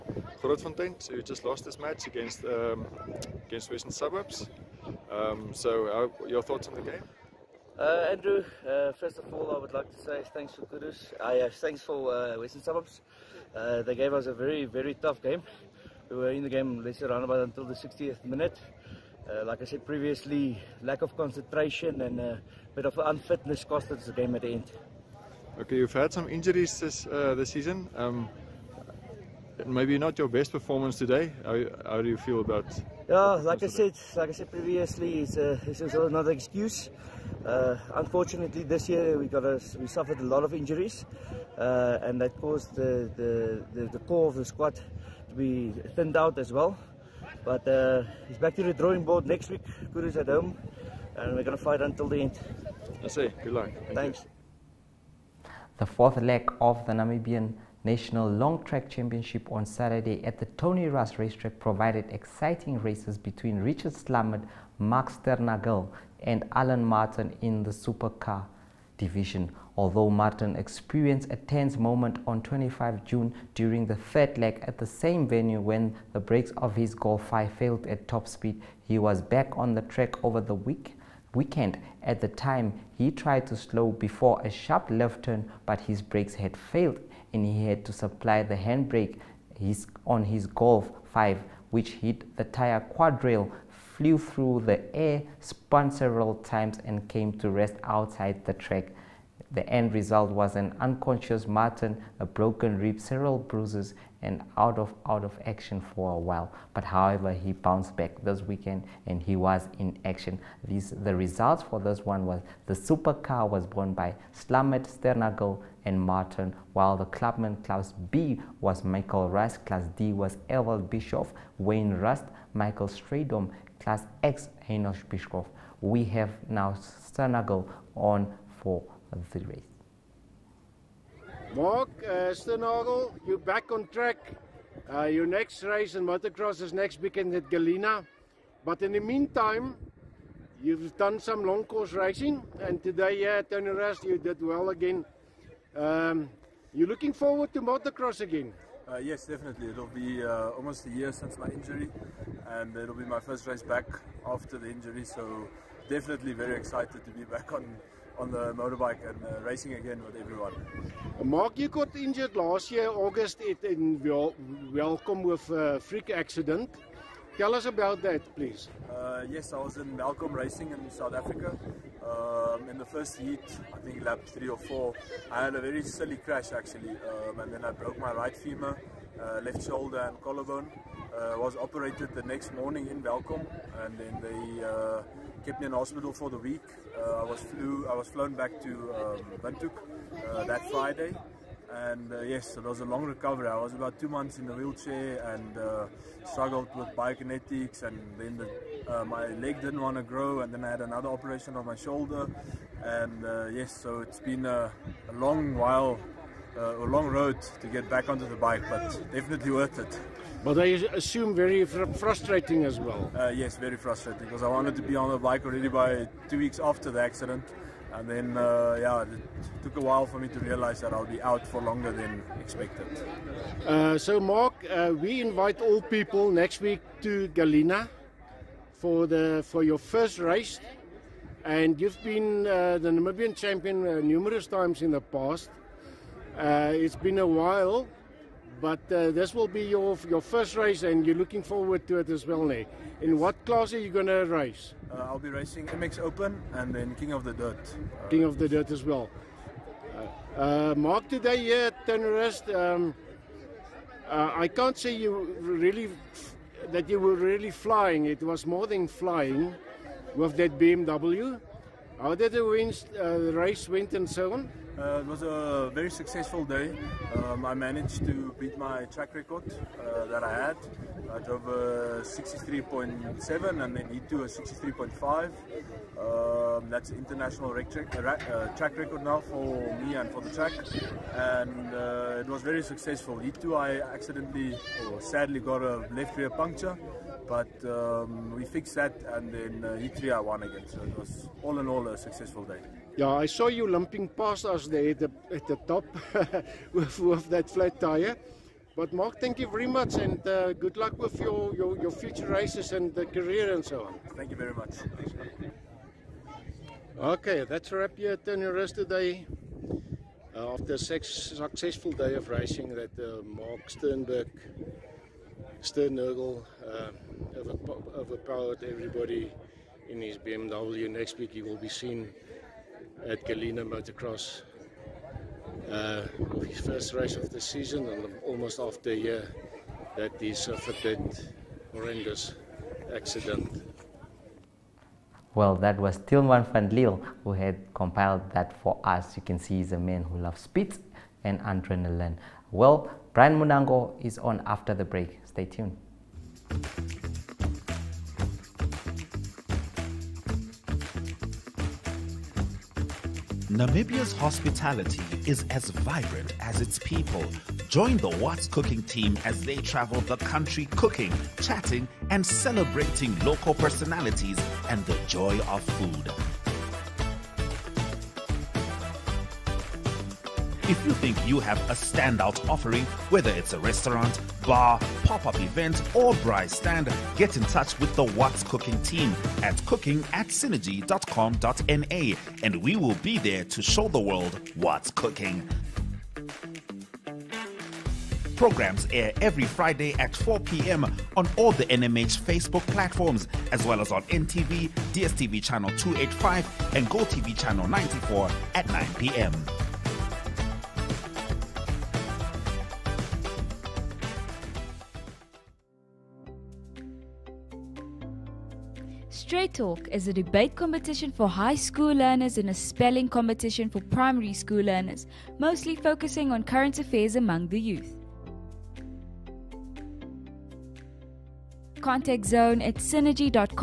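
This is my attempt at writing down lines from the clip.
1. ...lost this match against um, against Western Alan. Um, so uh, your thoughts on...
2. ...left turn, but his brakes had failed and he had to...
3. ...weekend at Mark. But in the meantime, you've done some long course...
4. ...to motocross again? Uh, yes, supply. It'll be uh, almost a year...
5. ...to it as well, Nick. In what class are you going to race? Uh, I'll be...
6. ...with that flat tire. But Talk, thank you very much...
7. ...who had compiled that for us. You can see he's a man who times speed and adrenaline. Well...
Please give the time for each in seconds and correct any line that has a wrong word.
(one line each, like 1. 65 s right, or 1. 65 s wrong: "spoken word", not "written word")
1. 1 s wrong: "Suburbs", not "Alan"
2. 84 s right
3. 137 s wrong: "Galena", not "Mark"
4. 147 s wrong: "definitely", not "supply"
5. 241 s right
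6. 296 s wrong: "Mark", not "Talk"
7. 337 s wrong: "loves", not "times".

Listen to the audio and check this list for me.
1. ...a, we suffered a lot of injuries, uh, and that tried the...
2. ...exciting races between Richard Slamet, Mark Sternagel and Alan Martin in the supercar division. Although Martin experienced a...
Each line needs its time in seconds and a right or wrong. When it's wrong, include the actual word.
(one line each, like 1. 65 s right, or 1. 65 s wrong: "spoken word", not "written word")
1. 39 s wrong: "caused", not "tried"
2. 62 s right.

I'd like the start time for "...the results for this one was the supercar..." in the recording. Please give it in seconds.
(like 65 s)
111 s.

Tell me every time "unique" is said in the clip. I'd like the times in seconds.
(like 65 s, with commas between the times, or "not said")
not said.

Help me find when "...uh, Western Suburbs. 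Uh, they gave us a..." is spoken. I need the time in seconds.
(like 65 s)
12 s.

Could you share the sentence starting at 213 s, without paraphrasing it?
Uh, yes, very frustrating because I wanted to be on the bike already by two weeks after the accident.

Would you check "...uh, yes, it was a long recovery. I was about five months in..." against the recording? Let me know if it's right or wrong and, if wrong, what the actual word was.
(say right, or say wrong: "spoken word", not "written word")
wrong: "two", not "five".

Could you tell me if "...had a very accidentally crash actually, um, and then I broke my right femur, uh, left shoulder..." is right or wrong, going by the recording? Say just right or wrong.
wrong.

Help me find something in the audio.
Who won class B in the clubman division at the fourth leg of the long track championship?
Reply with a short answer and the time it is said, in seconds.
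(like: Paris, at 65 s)
Michael Rust, at 118 s.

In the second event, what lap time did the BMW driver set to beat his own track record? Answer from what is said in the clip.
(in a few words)
63.5.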